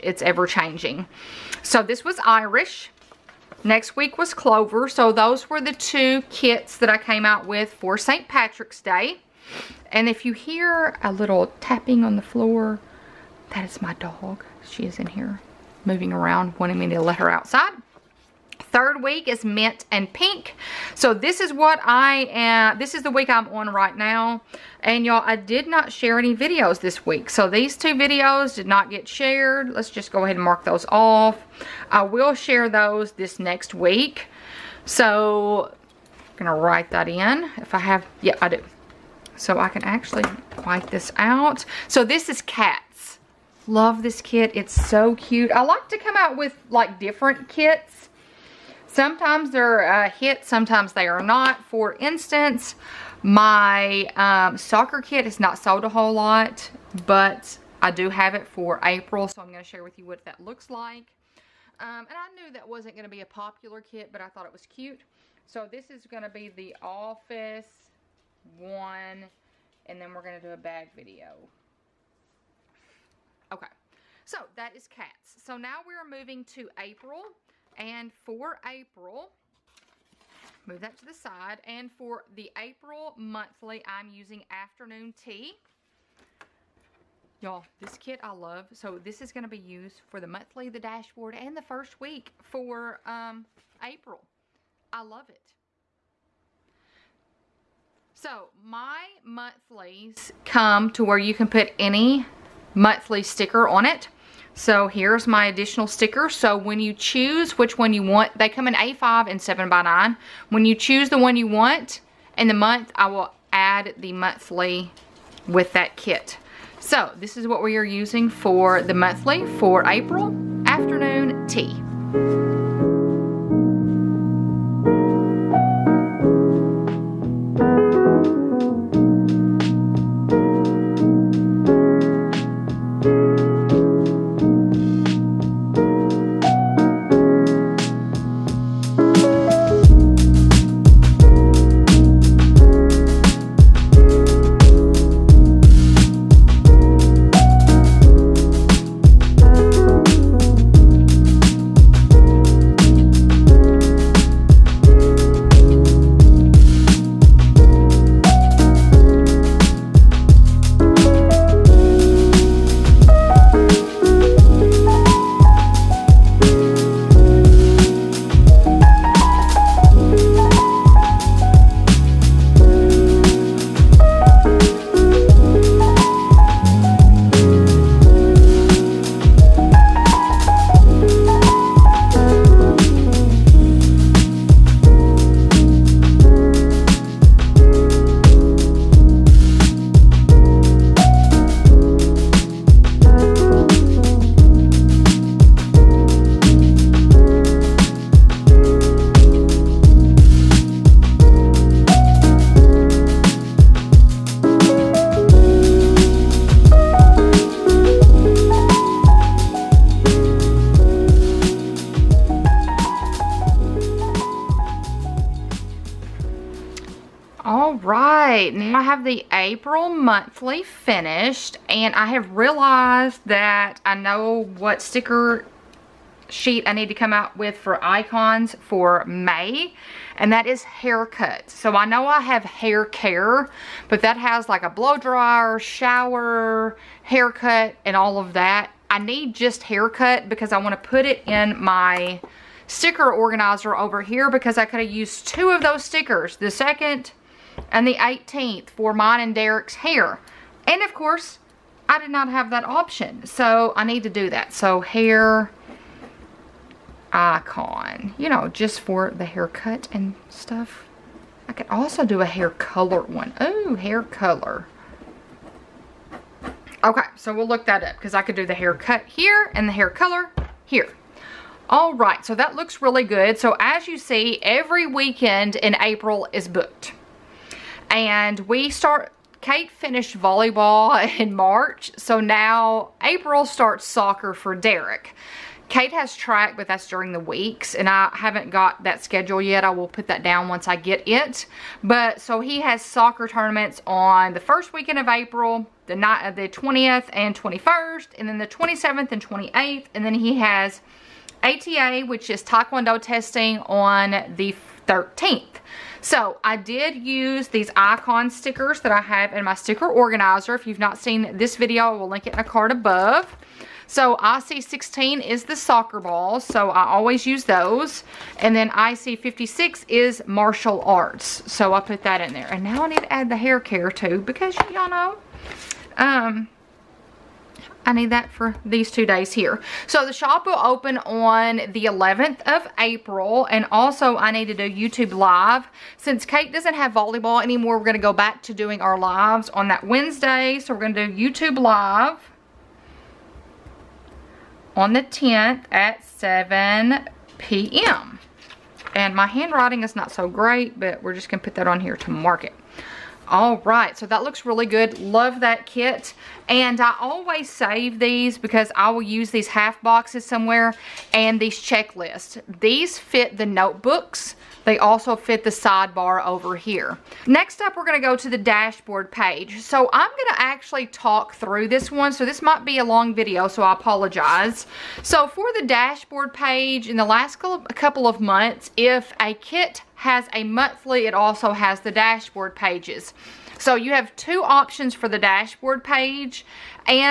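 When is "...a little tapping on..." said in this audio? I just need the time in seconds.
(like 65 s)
11 s.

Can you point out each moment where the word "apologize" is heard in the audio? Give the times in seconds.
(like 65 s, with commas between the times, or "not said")
373 s.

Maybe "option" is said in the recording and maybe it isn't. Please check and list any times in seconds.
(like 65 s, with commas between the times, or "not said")
252 s, 384 s.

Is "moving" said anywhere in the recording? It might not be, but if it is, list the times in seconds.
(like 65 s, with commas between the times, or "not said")
15 s, 76 s.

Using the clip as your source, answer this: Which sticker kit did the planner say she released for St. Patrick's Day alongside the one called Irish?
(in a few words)
Clover.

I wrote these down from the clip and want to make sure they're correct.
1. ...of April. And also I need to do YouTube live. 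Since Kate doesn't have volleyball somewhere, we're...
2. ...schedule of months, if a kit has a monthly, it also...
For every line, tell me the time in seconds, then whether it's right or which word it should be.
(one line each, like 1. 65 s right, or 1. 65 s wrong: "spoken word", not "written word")
1. 332 s wrong: "anymore", not "somewhere"
2. 377 s wrong: "couple", not "schedule".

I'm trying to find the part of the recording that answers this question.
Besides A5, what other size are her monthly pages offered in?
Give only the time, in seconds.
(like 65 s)
109 s.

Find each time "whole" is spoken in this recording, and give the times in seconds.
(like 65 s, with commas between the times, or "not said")
55 s.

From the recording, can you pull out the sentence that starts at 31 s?
I will share those this next week.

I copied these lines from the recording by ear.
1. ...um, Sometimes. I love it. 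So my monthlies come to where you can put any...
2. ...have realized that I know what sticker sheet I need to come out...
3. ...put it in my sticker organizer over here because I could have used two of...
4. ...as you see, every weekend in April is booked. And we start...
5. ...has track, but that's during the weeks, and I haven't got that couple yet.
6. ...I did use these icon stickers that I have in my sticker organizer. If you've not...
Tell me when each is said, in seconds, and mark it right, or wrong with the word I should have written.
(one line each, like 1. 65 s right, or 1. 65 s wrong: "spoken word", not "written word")
1. 93 s wrong: "April", not "Sometimes"
2. 222 s right
3. 240 s right
4. 273 s right
5. 285 s wrong: "schedule", not "couple"
6. 306 s right.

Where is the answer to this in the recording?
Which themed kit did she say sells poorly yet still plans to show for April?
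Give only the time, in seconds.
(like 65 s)
54 s.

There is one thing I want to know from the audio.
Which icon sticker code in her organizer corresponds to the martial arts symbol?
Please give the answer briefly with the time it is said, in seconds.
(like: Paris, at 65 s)
IC56, at 318 s.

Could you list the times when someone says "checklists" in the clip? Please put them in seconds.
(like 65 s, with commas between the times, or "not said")
361 s.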